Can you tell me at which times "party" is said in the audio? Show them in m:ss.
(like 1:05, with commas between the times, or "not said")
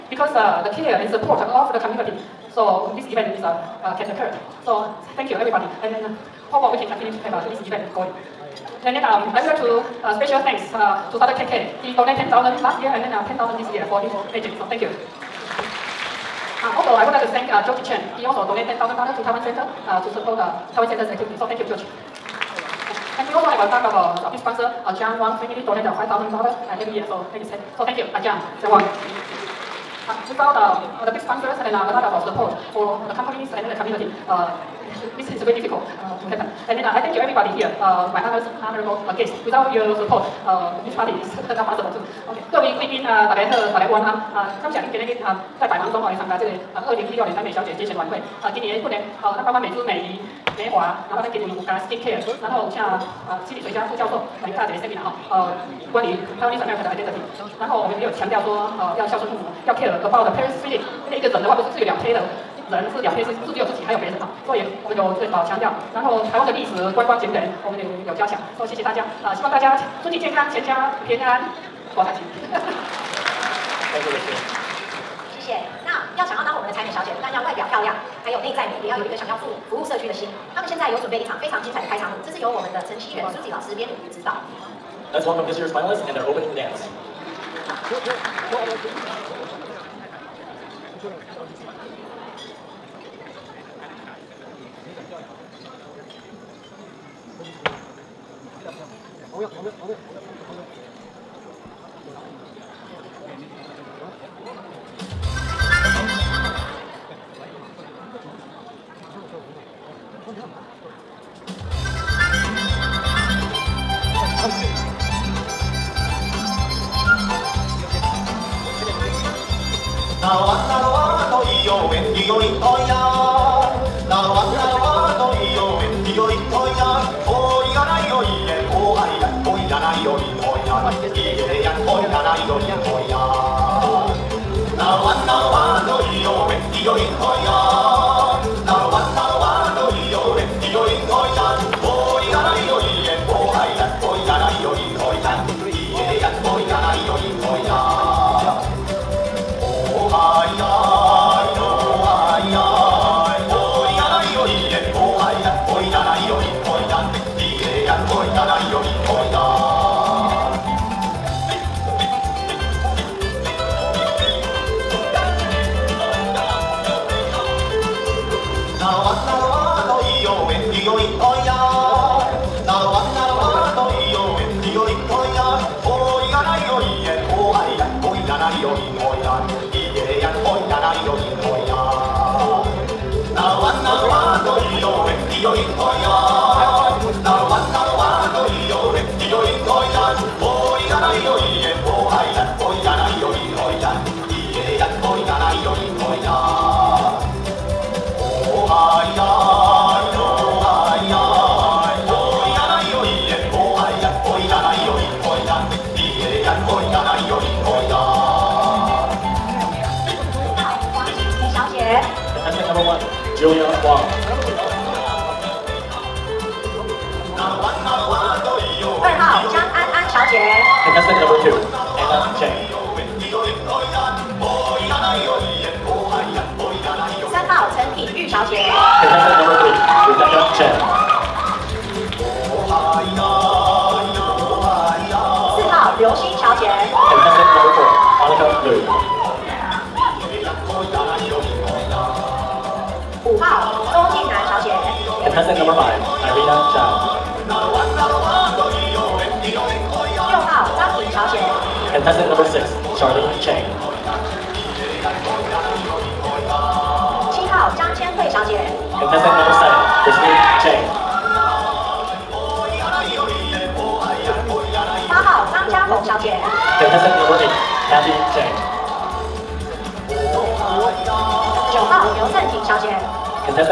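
0:40.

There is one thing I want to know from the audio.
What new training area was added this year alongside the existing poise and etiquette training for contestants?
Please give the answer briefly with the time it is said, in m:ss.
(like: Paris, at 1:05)
skincare, at 0:51.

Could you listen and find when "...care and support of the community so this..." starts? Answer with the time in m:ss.
0:00.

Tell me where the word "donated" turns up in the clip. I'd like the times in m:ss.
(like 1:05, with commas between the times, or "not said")
0:11, 0:18, 0:25.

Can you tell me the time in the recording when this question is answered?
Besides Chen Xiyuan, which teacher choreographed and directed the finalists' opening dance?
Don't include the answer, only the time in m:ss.
1:23.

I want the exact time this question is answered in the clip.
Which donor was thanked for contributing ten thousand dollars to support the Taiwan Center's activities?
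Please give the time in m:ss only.
0:17.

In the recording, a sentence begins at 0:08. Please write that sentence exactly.
And then um, I would like to uh, special thanks uh, to Dr.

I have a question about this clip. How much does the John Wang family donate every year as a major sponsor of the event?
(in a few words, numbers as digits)
$5,000.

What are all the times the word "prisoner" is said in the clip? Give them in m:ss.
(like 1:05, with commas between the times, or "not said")
not said.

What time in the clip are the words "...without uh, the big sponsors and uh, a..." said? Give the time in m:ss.
0:30.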